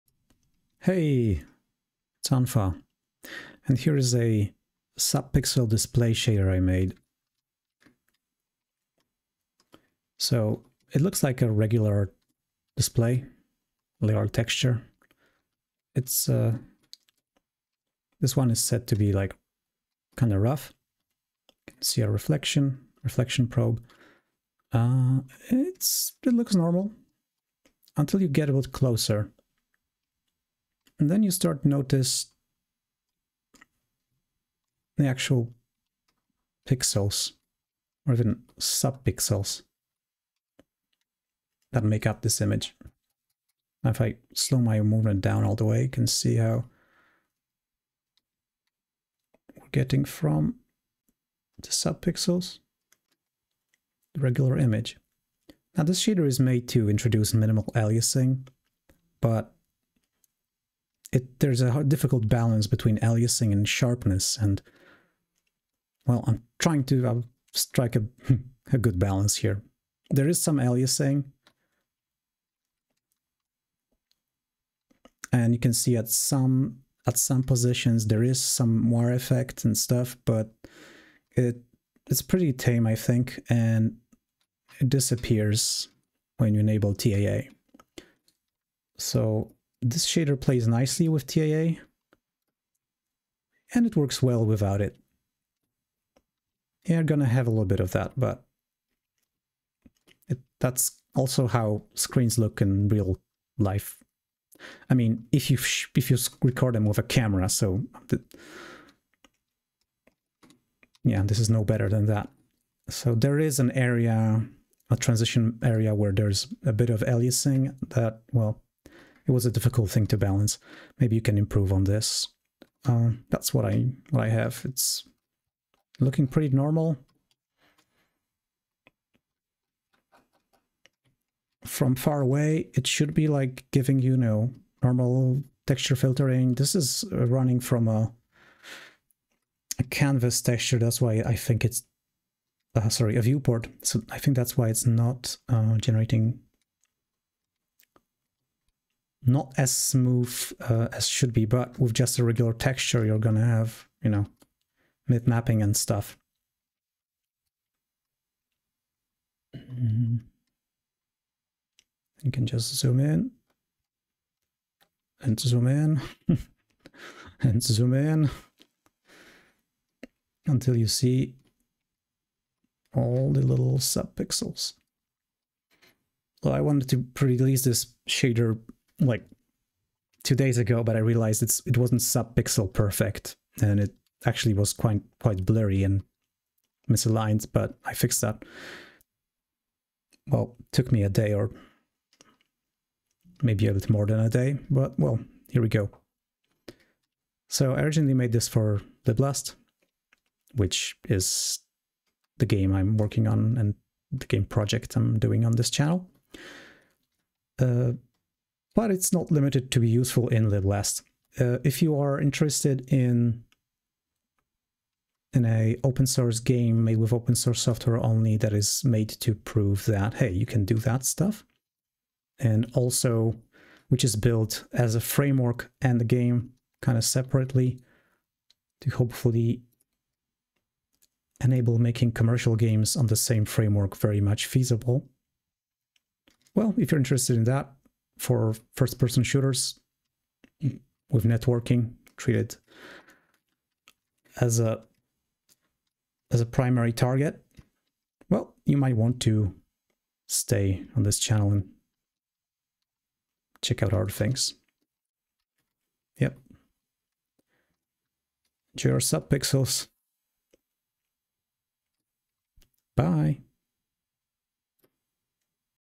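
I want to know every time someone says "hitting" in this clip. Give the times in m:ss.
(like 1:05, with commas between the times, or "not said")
not said.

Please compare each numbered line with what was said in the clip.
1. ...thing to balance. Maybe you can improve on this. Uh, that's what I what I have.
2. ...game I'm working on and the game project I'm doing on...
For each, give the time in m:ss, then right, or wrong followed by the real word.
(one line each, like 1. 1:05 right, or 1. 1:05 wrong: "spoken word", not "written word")
1. 1:59 right
2. 3:22 right.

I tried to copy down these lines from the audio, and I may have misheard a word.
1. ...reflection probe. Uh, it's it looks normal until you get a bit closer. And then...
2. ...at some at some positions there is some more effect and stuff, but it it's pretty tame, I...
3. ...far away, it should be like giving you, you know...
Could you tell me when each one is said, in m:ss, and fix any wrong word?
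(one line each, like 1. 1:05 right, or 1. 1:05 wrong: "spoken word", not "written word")
1. 0:23 right
2. 1:15 right
3. 2:11 right.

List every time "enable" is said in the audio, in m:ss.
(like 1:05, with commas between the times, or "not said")
1:26, 3:51.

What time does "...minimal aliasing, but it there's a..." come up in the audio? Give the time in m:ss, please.
0:57.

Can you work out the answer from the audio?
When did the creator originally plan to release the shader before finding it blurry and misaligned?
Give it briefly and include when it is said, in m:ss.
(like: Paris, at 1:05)
2 days ago, at 3:00.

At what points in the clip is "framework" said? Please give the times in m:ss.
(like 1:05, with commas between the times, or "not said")
3:45, 3:53.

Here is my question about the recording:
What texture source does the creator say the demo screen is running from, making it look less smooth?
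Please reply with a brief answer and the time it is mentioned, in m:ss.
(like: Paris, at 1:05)
A viewport, at 2:23.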